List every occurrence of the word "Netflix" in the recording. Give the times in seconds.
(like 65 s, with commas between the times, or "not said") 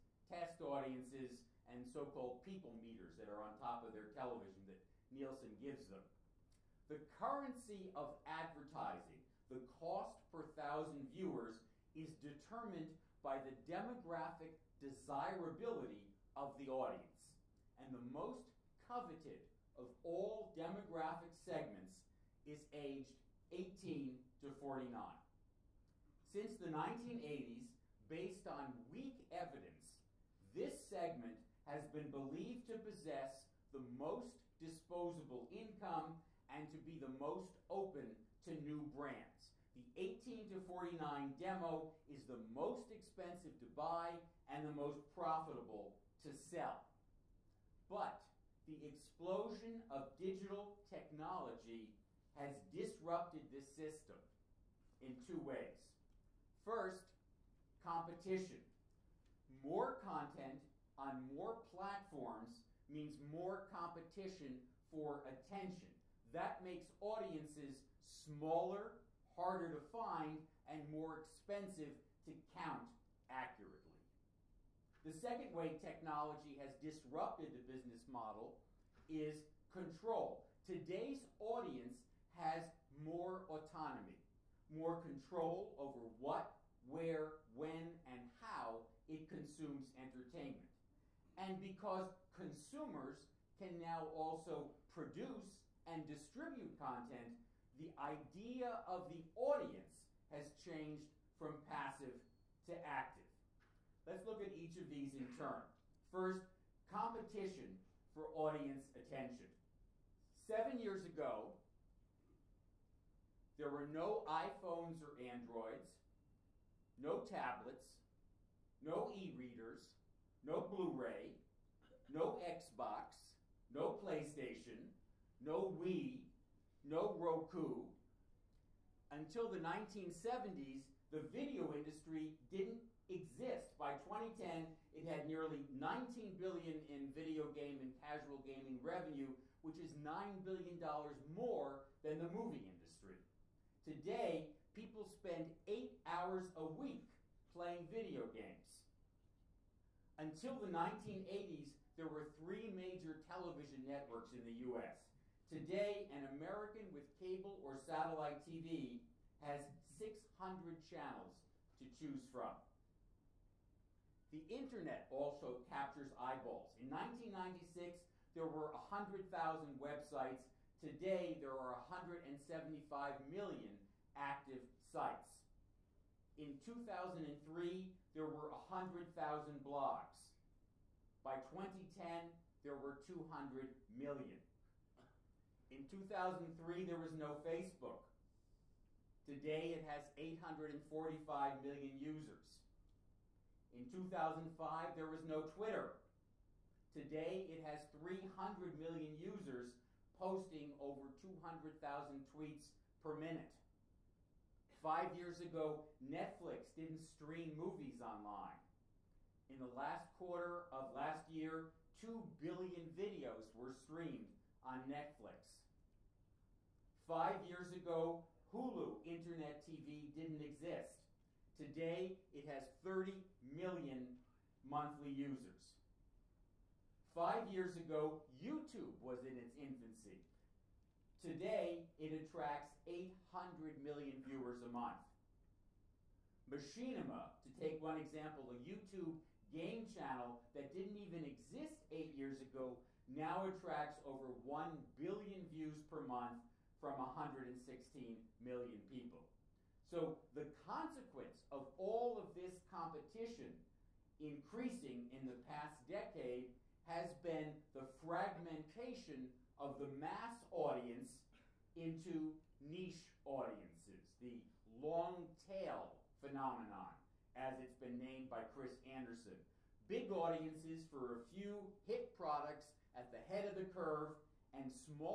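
206 s, 214 s.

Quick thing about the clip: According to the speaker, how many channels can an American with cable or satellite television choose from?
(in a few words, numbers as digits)
600.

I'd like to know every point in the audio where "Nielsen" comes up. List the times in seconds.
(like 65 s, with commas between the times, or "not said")
5 s.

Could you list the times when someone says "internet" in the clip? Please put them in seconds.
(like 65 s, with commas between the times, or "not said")
164 s, 219 s.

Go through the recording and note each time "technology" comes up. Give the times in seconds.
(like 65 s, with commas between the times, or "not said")
50 s, 75 s.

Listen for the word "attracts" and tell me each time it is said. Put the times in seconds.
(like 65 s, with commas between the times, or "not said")
232 s, 243 s.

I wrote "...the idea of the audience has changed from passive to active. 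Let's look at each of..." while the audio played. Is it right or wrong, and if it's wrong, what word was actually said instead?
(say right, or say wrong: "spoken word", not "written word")
right.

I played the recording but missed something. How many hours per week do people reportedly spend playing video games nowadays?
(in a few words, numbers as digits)
8 hours.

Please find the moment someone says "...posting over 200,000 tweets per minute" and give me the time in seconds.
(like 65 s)
200 s.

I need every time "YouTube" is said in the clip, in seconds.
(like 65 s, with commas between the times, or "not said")
228 s, 238 s.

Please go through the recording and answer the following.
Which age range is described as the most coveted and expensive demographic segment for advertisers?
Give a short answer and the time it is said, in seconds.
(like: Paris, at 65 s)
18 to 49, at 22 s.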